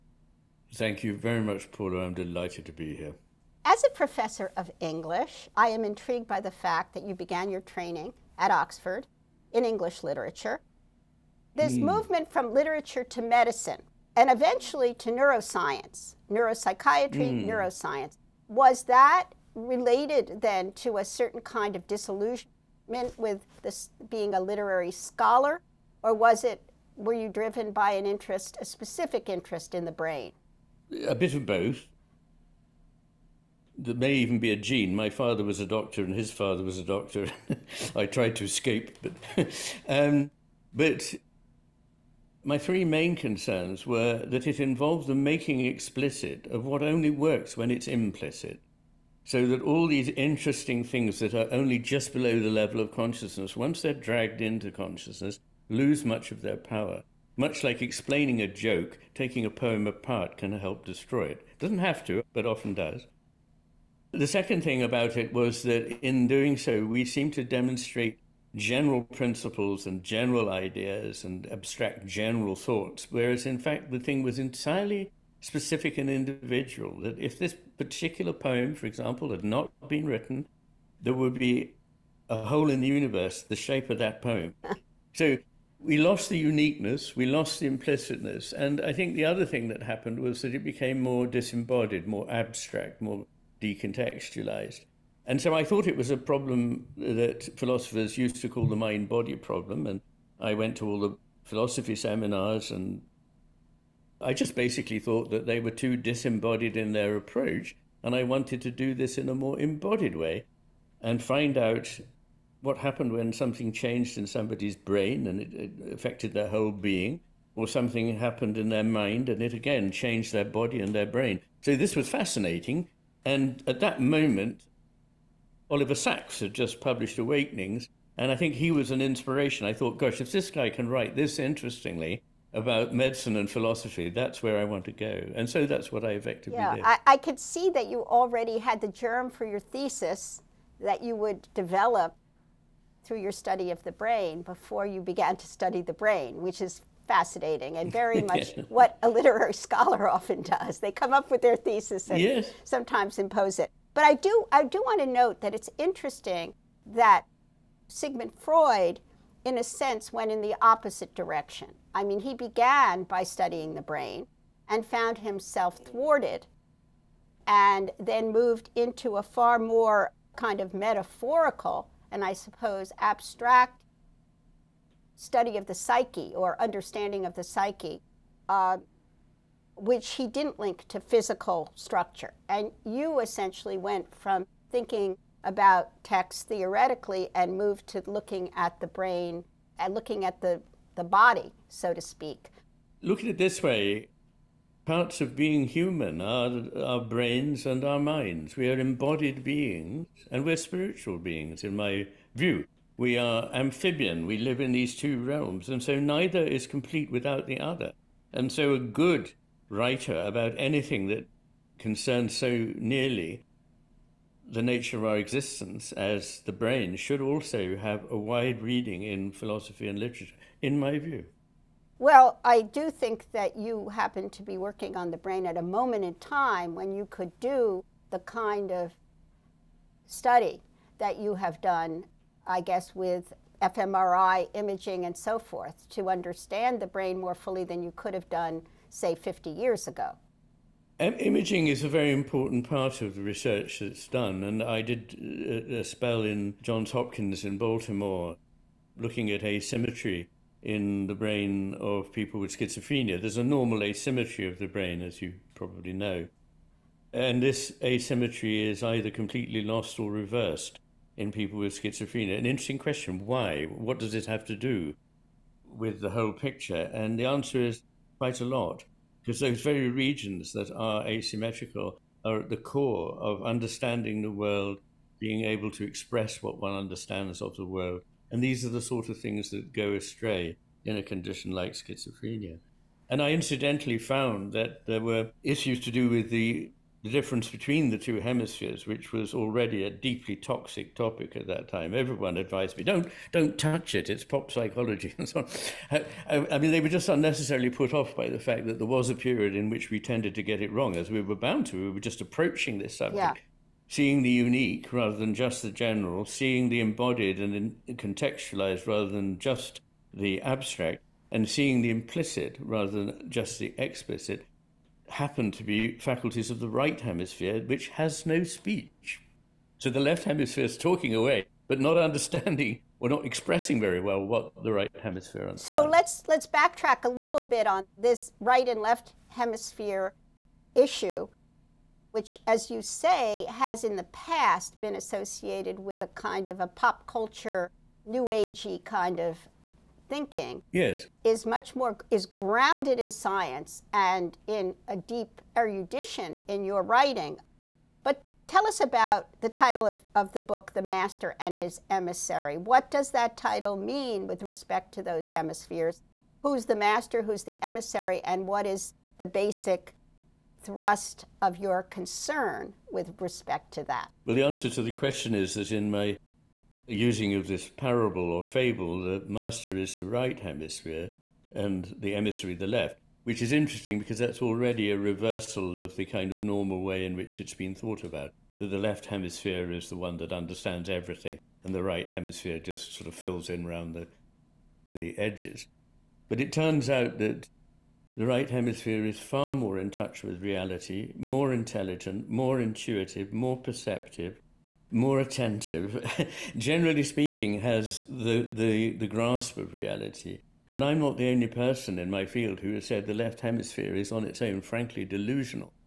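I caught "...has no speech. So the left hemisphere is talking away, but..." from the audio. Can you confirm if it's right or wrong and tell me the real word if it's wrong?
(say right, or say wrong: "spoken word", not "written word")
right.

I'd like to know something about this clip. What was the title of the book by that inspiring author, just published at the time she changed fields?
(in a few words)
Awakenings.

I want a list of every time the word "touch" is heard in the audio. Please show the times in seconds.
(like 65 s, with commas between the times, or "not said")
293 s, 389 s.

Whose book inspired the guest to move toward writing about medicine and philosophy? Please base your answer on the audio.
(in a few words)
Oliver Sacks.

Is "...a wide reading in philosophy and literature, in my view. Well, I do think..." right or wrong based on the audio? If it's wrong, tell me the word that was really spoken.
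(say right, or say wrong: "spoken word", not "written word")
right.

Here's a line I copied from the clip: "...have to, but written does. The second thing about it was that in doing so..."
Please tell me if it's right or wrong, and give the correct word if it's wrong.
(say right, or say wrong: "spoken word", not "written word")
wrong: "often", not "written".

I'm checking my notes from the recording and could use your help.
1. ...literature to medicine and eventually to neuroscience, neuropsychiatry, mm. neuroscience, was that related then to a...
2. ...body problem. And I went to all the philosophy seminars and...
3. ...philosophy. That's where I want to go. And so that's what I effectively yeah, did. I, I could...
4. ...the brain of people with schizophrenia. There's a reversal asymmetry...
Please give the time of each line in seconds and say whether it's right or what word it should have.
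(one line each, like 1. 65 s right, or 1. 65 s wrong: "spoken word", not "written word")
1. 12 s right
2. 99 s right
3. 133 s right
4. 251 s wrong: "normal", not "reversal".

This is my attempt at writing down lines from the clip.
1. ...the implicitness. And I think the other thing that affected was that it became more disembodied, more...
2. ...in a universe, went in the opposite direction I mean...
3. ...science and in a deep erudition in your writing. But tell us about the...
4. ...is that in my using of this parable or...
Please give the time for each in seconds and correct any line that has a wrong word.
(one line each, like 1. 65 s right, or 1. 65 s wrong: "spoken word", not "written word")
1. 87 s wrong: "happened", not "affected"
2. 159 s wrong: "sense", not "universe"
3. 343 s right
4. 365 s right.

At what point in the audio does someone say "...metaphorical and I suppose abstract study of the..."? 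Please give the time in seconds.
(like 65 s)
170 s.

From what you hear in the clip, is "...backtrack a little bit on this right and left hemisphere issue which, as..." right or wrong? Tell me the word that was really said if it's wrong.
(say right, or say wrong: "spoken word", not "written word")
right.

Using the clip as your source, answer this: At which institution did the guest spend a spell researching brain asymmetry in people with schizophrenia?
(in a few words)
Johns Hopkins.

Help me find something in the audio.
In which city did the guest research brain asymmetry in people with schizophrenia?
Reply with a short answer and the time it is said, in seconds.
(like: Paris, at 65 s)
Baltimore, at 247 s.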